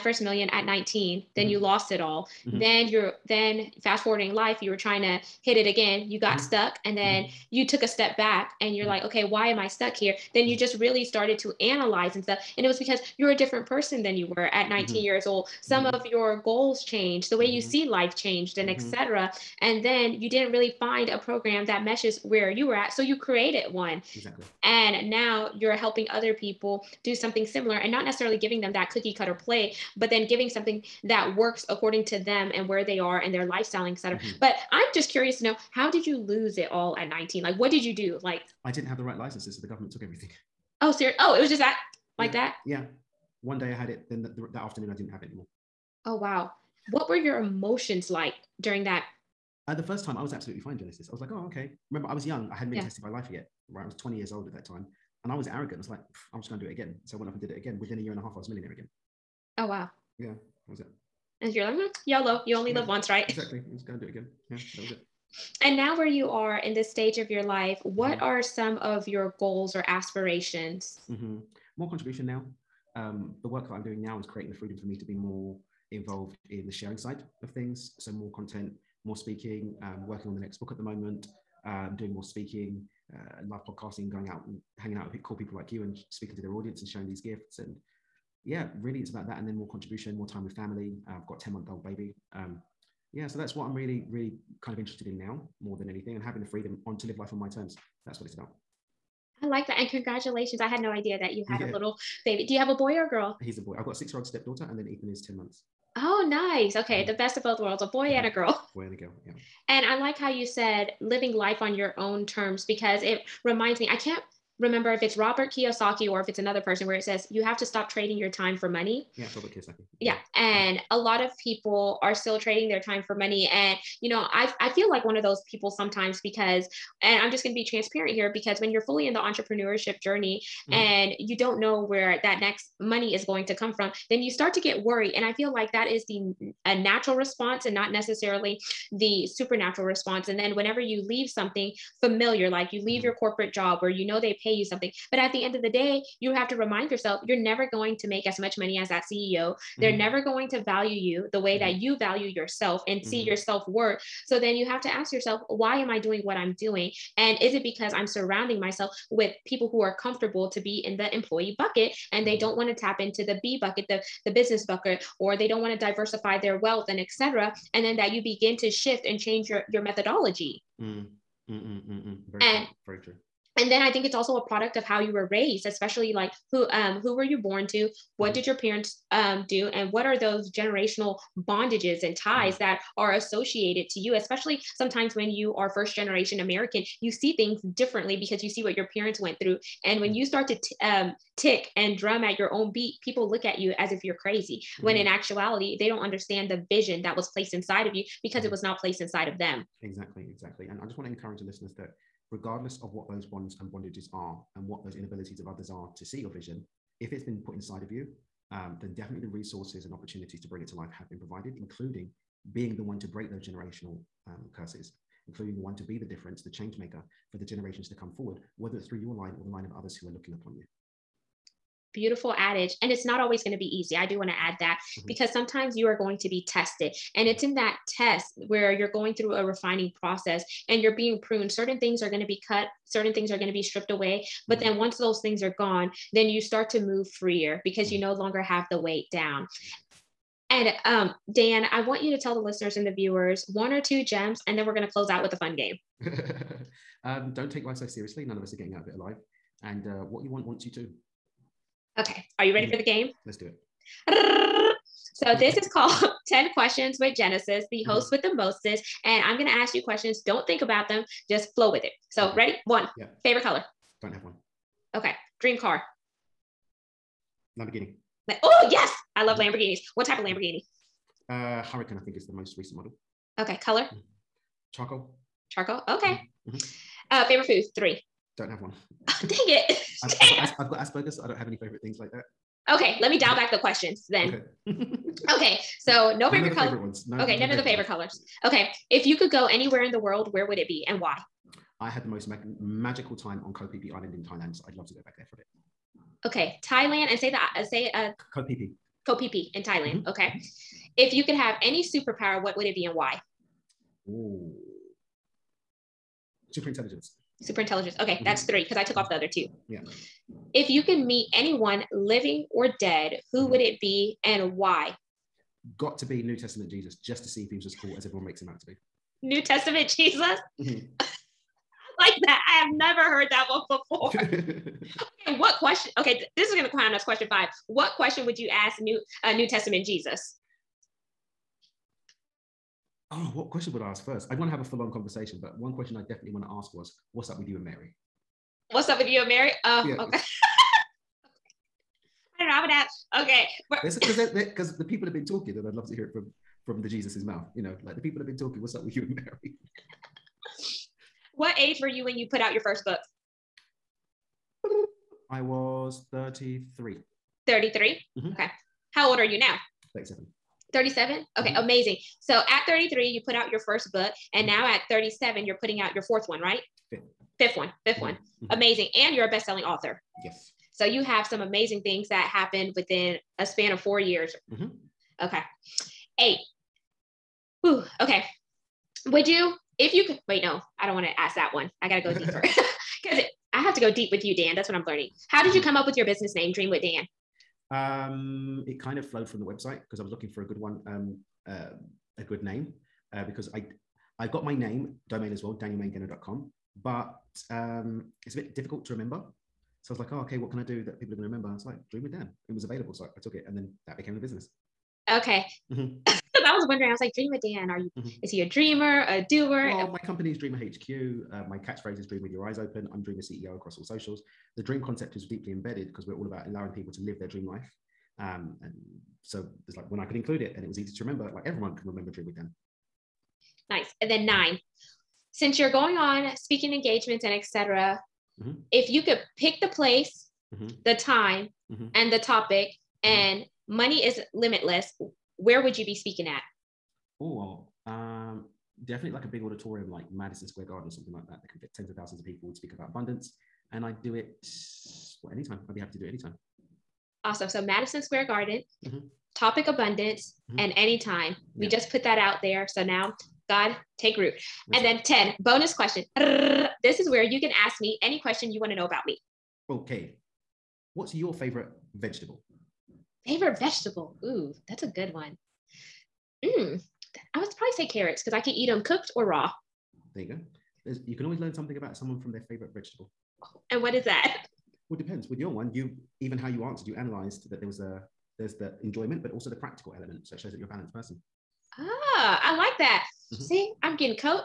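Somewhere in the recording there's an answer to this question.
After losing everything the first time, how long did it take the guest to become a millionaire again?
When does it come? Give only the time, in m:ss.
0:57.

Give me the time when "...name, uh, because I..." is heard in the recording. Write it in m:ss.
6:32.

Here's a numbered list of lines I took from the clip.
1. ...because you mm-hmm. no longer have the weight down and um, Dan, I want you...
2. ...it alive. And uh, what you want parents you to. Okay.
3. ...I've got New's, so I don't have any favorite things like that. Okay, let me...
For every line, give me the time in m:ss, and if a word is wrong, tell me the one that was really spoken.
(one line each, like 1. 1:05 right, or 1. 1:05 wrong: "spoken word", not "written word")
1. 3:57 right
2. 4:08 wrong: "wants", not "parents"
3. 4:40 wrong: "Asperger", not "New".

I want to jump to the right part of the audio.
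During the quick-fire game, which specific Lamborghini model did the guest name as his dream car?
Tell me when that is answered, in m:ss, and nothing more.
4:31.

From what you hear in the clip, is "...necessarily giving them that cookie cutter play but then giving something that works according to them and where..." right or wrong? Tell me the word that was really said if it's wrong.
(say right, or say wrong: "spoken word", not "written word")
right.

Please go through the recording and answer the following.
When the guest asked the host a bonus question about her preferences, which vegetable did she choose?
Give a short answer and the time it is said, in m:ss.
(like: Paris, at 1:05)
Carrots, at 7:47.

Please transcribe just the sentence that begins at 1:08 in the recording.
are some of your goals or aspirations?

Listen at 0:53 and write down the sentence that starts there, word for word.
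Right, I was 20 years old at that time.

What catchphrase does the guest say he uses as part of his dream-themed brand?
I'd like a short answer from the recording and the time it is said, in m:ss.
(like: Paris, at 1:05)
Dream with your eyes open, at 6:52.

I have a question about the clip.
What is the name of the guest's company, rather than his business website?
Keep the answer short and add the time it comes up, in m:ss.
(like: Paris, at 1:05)
Dreamer HQ, at 6:50.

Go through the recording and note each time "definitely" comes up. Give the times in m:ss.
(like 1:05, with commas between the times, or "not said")
3:28, 5:36, 7:18.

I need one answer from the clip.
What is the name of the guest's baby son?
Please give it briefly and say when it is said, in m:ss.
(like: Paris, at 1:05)
Ethan, at 1:44.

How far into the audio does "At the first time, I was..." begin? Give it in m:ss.
0:49.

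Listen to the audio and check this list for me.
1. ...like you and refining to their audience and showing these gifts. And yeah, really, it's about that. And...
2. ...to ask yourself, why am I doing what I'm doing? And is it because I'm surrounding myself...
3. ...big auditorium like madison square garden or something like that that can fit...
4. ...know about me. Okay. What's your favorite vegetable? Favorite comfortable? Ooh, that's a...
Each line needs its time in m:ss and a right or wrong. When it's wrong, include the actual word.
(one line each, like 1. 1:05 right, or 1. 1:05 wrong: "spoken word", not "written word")
1. 1:25 wrong: "speaking", not "refining"
2. 2:34 right
3. 7:19 right
4. 7:38 wrong: "vegetable", not "comfortable".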